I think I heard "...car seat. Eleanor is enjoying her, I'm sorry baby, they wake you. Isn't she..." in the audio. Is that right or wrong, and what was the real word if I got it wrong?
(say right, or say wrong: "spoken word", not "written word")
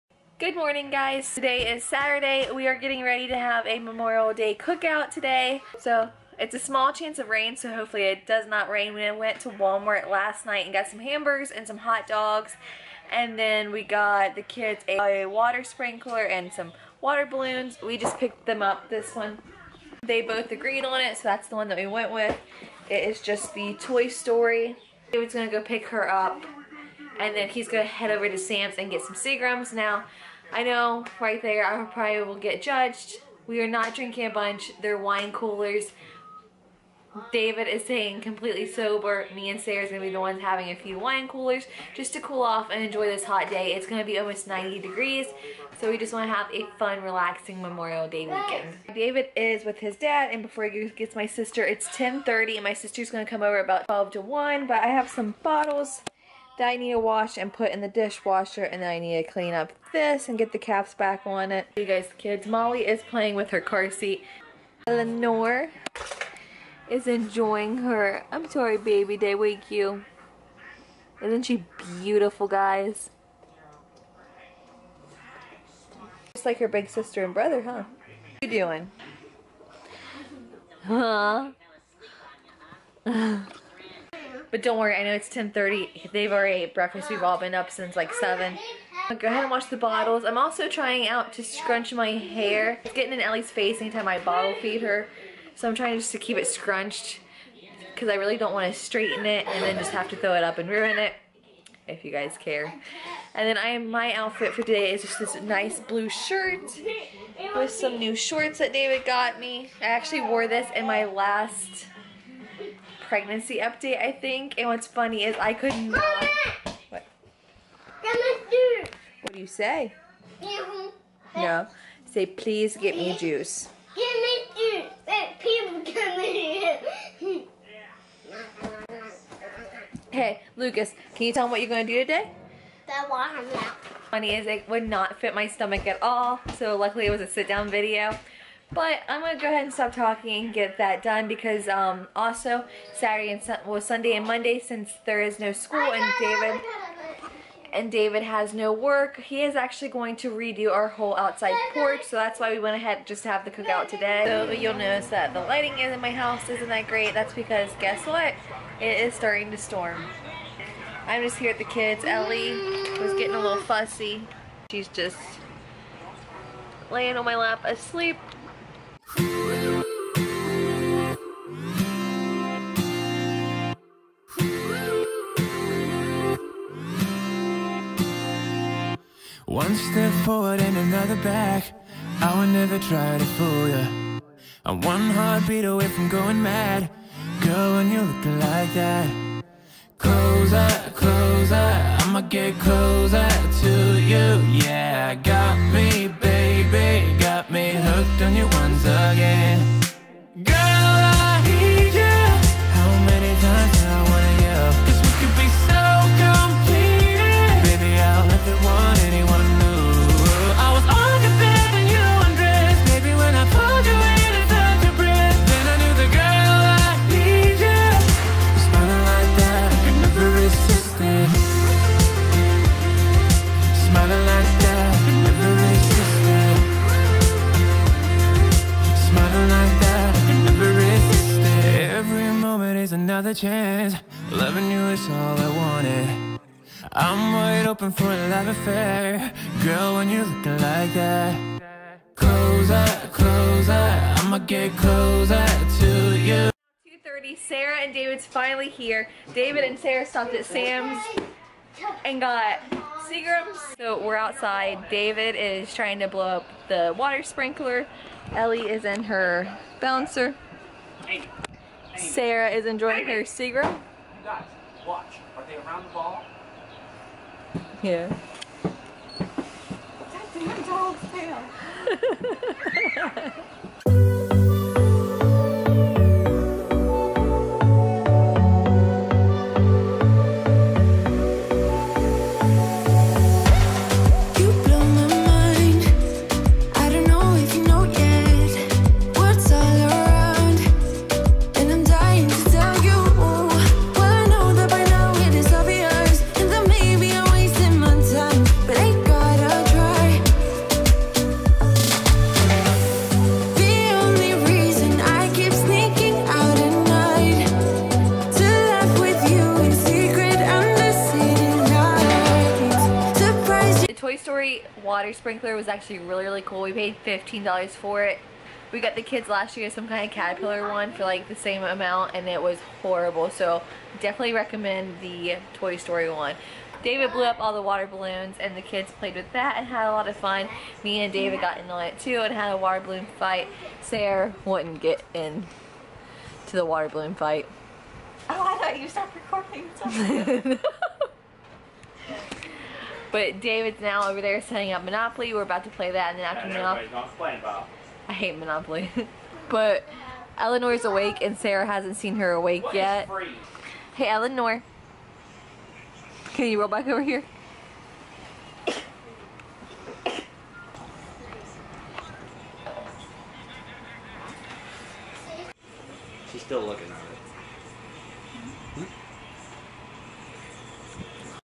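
right.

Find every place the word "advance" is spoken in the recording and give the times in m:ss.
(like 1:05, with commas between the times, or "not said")
not said.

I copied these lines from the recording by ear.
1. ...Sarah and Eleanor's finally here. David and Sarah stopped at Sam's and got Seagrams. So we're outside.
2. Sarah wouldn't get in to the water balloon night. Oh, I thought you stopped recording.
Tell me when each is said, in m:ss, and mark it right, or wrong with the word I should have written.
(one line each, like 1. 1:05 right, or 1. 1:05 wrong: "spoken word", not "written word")
1. 4:07 wrong: "David", not "Eleanor"
2. 5:33 wrong: "fight", not "night".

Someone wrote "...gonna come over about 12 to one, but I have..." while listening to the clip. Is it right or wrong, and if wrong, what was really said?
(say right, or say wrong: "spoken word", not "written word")
right.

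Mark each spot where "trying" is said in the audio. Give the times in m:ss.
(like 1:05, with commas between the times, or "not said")
1:30, 1:35, 4:15.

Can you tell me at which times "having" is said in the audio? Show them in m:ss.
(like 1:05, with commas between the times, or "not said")
0:40.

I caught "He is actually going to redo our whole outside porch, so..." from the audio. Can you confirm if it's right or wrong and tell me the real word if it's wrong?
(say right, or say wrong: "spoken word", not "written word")
right.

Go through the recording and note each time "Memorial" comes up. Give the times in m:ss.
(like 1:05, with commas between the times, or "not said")
0:03, 0:47.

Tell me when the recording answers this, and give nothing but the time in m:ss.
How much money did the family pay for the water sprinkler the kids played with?
5:17.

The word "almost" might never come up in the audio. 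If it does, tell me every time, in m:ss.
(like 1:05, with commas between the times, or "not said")
0:44.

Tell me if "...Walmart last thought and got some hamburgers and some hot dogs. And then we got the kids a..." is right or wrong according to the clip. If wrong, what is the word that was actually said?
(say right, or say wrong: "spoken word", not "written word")
wrong: "night", not "thought".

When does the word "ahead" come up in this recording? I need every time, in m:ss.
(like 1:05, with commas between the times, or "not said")
1:29, 2:19, 2:32.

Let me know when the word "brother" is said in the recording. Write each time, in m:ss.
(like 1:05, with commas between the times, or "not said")
1:17.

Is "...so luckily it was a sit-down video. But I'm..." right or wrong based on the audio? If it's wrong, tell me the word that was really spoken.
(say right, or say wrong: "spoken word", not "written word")
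right.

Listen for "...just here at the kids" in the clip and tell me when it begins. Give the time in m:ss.
2:41.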